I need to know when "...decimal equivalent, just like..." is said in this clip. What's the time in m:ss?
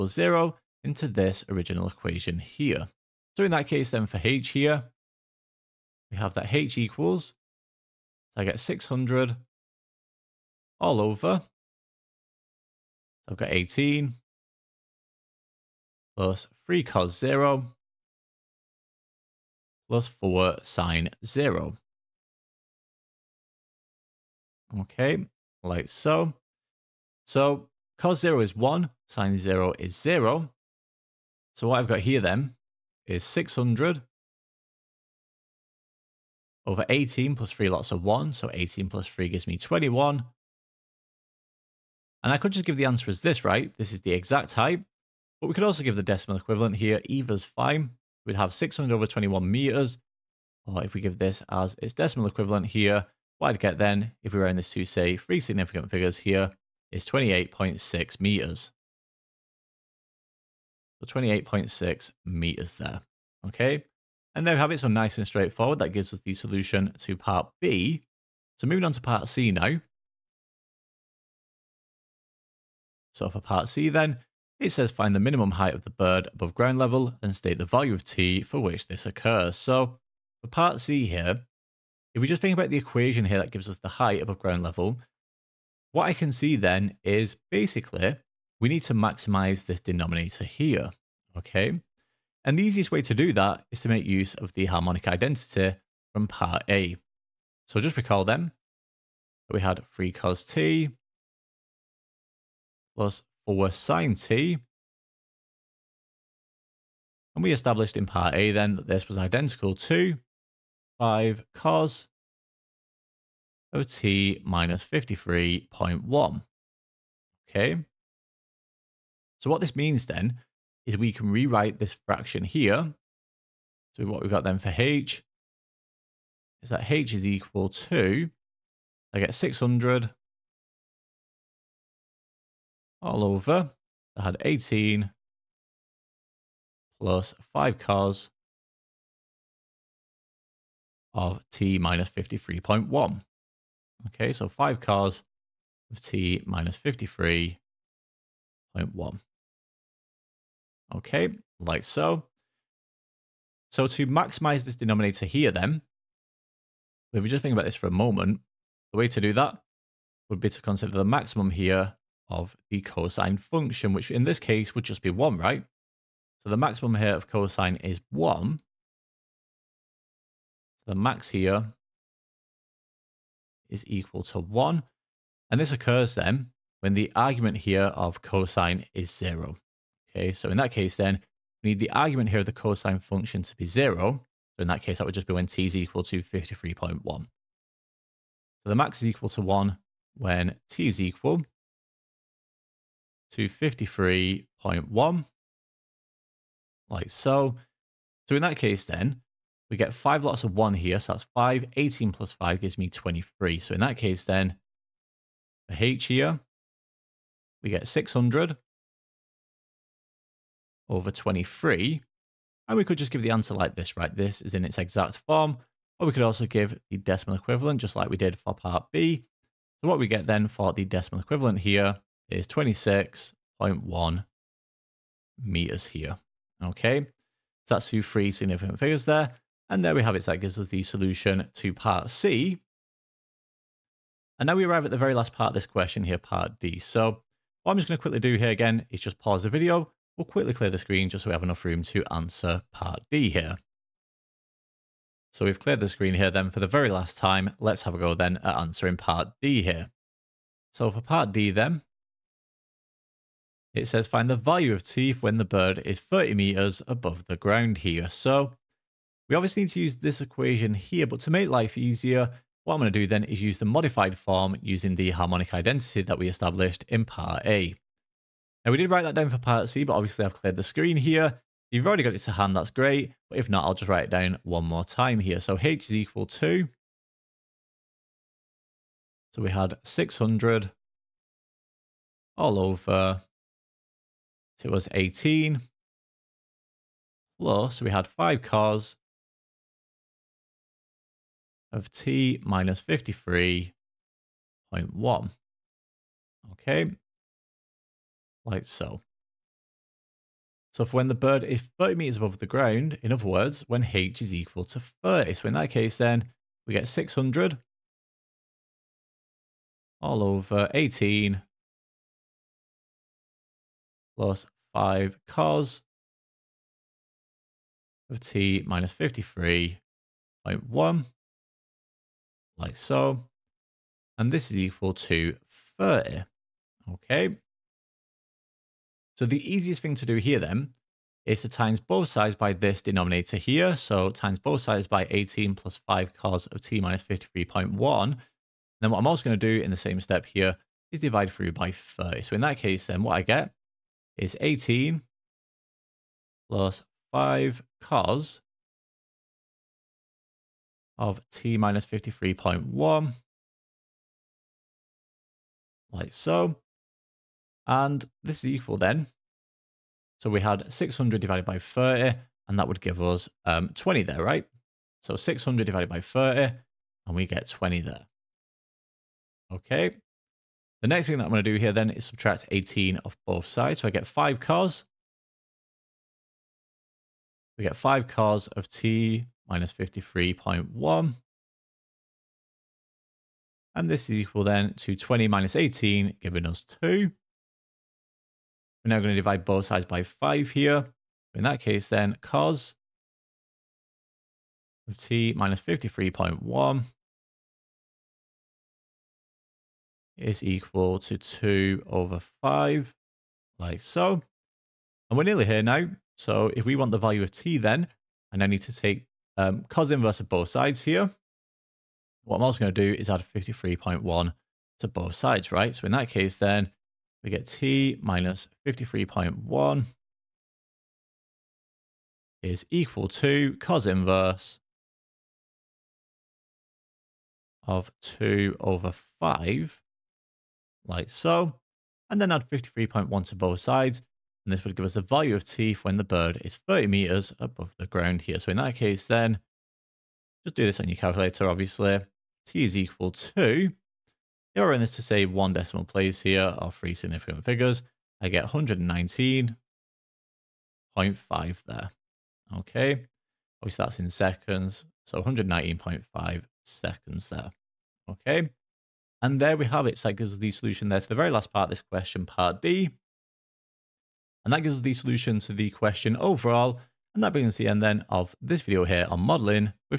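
3:36.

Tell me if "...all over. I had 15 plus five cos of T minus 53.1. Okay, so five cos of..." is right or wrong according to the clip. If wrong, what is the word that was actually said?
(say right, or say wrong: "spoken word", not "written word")
wrong: "18", not "15".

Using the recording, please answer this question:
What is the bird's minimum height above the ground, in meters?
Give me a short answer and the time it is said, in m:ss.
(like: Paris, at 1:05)
26.1 meters, at 3:42.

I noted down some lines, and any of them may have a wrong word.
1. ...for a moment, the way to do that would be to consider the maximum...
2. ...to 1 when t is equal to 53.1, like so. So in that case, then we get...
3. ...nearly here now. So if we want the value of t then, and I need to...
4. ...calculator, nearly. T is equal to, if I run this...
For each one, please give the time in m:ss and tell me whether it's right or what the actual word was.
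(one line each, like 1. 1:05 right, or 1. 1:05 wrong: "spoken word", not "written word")
1. 2:37 right
2. 3:09 right
3. 6:45 right
4. 7:20 wrong: "obviously", not "nearly".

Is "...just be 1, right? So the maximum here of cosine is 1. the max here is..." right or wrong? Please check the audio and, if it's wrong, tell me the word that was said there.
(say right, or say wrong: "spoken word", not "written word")
right.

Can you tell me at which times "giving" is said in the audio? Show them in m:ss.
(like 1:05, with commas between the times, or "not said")
6:26.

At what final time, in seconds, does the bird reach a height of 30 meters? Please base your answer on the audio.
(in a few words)
119.5 seconds.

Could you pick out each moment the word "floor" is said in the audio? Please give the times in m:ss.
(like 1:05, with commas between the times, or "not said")
not said.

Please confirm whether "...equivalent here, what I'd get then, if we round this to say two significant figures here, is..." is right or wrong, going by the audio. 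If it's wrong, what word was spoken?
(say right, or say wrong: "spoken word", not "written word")
wrong: "three", not "two".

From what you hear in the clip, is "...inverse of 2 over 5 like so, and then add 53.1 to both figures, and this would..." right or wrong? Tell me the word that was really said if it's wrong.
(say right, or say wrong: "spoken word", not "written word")
wrong: "sides", not "figures".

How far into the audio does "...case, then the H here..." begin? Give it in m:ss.
3:23.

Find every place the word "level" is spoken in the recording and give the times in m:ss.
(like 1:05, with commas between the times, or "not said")
1:16, 1:24.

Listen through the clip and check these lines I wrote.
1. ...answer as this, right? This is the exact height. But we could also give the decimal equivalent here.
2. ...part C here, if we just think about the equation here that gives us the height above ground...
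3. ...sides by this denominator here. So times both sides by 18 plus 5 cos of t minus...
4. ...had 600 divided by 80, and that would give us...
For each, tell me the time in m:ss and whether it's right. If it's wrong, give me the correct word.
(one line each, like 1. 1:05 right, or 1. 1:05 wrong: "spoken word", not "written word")
1. 0:42 right
2. 1:20 right
3. 5:32 right
4. 6:00 wrong: "30", not "80".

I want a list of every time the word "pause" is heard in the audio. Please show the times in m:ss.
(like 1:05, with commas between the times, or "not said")
3:59.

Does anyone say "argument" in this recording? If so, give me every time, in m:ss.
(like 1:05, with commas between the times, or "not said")
2:57, 3:01.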